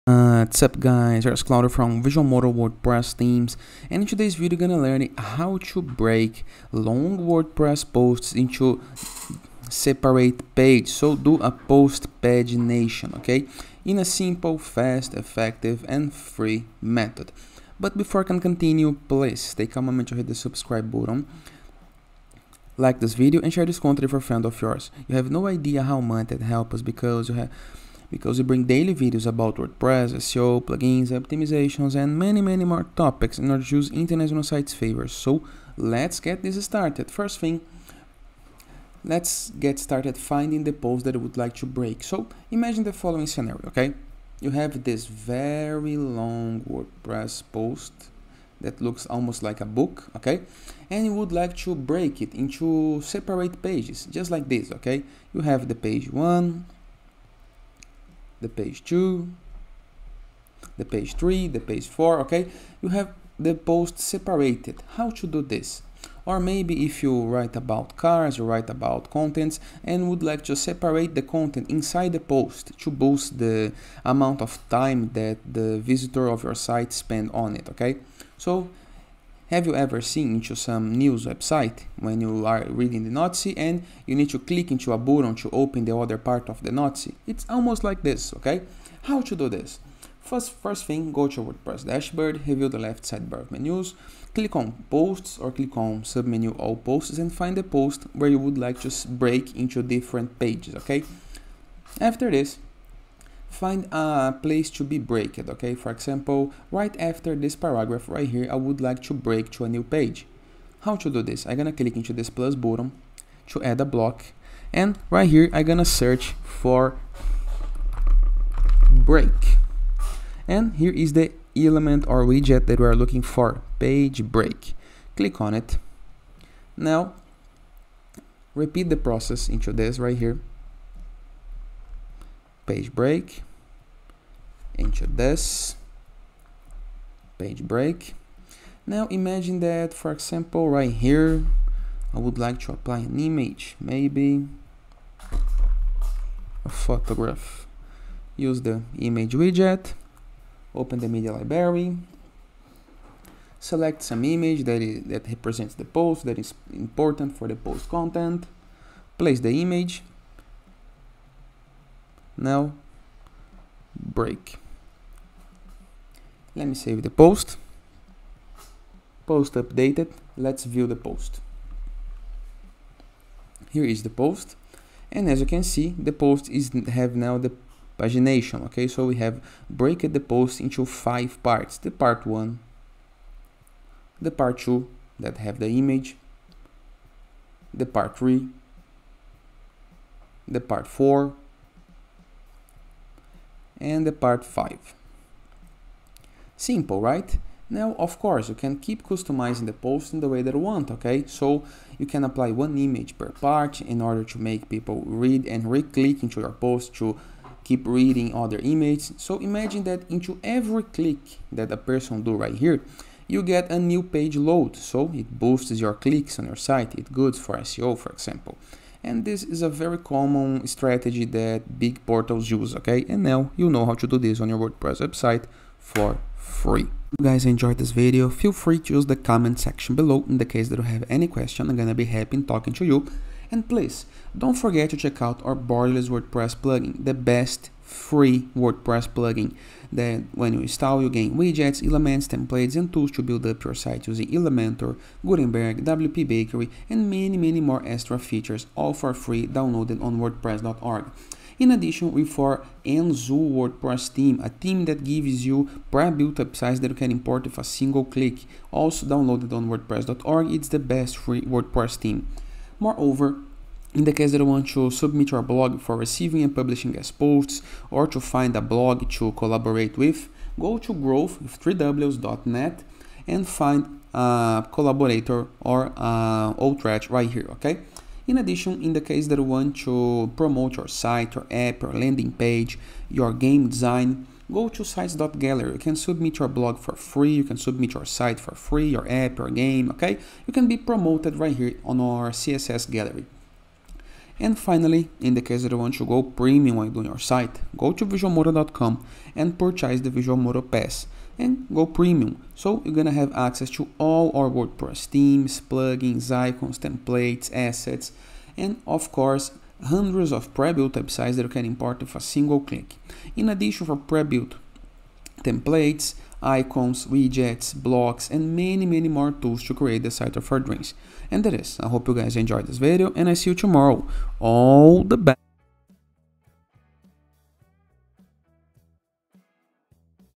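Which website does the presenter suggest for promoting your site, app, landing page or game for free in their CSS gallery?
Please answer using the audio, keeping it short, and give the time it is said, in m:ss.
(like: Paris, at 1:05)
sites.gallery, at 4:44.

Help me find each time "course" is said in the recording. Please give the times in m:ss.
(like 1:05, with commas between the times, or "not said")
3:18, 5:09.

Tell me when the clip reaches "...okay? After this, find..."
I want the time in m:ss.
1:40.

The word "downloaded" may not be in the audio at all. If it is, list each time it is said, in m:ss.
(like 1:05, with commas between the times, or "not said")
4:09, 4:19.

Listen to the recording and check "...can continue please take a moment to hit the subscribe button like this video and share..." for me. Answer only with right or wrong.
right.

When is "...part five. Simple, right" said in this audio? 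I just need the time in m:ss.
3:14.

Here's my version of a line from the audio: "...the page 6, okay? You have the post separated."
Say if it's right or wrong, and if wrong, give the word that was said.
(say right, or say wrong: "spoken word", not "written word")
wrong: "4", not "6".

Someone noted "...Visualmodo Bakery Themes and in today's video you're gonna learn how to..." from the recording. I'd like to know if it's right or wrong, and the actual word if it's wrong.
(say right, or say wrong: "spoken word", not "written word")
wrong: "WordPress", not "Bakery".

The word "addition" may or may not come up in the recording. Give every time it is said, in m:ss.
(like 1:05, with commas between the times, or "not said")
4:11, 4:38, 5:13.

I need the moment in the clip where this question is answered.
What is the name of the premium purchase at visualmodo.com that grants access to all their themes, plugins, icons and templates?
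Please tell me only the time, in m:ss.
5:00.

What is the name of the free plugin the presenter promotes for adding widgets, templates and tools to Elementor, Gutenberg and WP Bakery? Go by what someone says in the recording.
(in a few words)
Borderless.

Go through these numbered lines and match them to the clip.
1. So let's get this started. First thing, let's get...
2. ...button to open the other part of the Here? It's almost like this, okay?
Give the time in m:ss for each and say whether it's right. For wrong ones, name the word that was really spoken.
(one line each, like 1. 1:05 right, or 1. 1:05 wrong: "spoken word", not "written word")
1. 0:35 right
2. 1:24 wrong: "Nazi", not "Here".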